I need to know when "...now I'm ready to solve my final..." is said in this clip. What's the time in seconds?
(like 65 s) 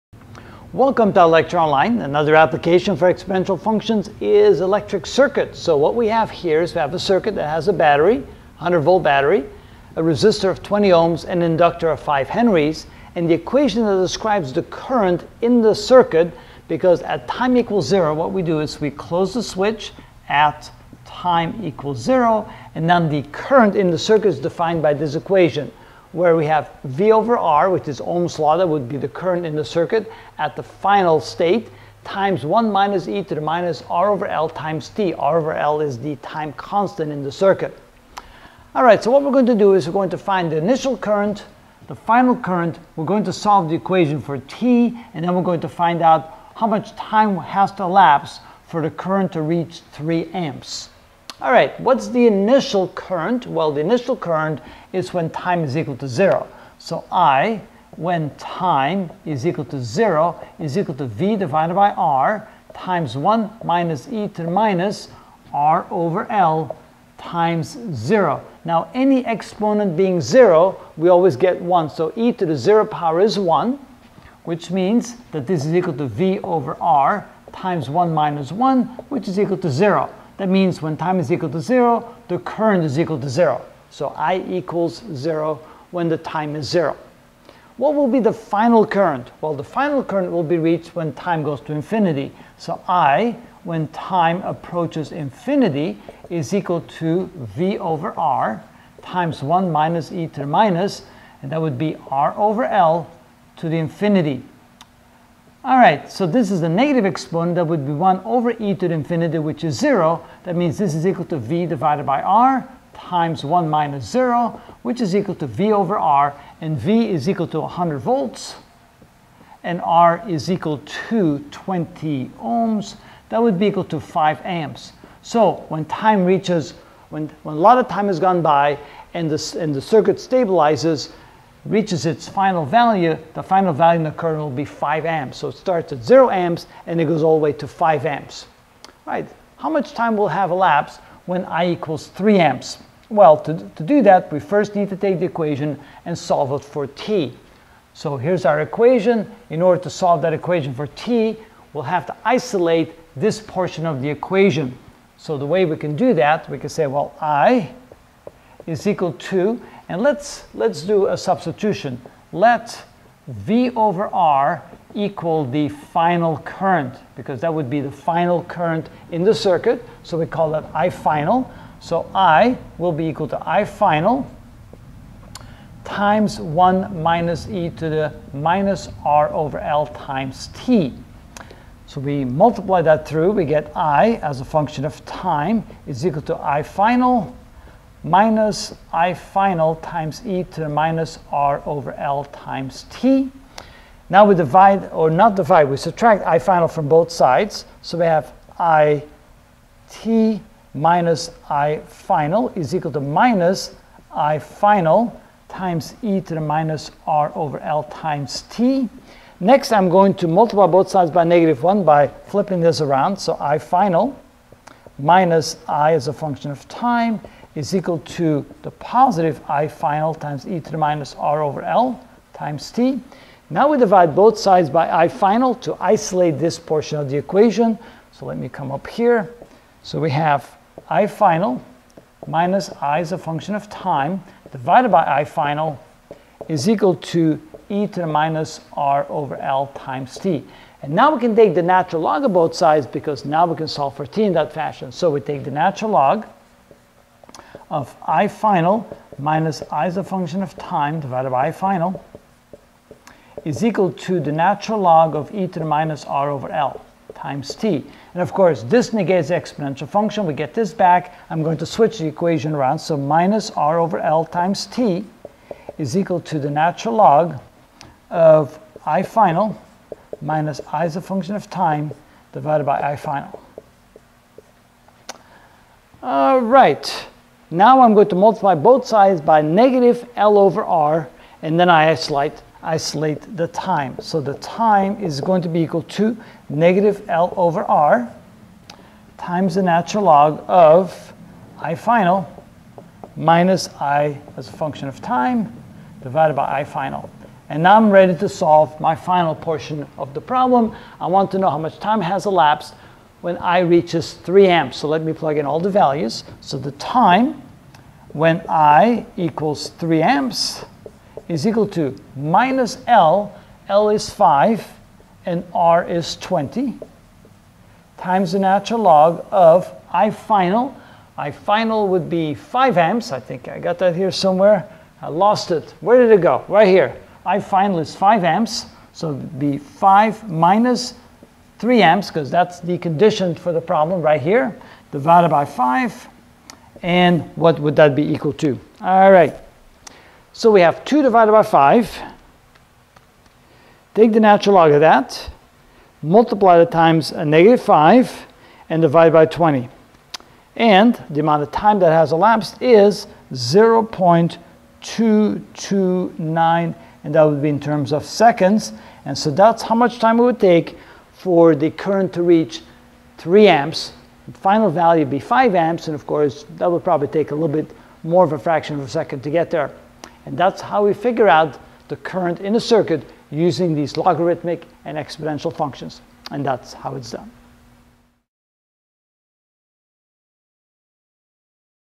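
297 s.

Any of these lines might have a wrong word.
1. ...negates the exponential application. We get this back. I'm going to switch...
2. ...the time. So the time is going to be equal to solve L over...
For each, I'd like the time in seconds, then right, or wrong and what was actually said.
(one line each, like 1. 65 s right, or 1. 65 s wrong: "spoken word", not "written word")
1. 258 s wrong: "function", not "application"
2. 283 s wrong: "negative", not "solve".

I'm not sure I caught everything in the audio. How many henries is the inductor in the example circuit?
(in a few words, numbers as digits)
5 henries.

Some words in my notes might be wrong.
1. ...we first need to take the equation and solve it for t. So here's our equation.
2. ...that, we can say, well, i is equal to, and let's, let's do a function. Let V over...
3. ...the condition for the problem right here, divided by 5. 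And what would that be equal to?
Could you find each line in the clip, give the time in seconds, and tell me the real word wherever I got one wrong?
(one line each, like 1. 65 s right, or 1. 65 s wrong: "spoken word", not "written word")
1. 144 s right
2. 156 s wrong: "substitution", not "function"
3. 332 s right.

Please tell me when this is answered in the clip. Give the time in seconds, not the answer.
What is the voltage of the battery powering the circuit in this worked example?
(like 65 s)
8 s.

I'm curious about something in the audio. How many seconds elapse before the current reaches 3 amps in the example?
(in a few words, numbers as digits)
0.229 seconds.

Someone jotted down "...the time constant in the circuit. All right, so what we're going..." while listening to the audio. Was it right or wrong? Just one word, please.
right.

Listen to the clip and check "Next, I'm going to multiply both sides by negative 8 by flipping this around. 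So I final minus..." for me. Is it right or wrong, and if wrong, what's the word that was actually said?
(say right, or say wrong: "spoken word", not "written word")
wrong: "1", not "8".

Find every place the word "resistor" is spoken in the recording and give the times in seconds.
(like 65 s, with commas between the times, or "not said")
10 s.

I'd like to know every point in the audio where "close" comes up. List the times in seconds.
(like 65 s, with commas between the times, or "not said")
18 s.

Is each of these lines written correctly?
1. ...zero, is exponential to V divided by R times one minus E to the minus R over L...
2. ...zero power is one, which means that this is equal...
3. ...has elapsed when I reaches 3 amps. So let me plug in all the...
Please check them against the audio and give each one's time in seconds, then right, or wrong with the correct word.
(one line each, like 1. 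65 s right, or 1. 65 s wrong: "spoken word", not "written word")
1. 59 s wrong: "equal", not "exponential"
2. 72 s right
3. 301 s right.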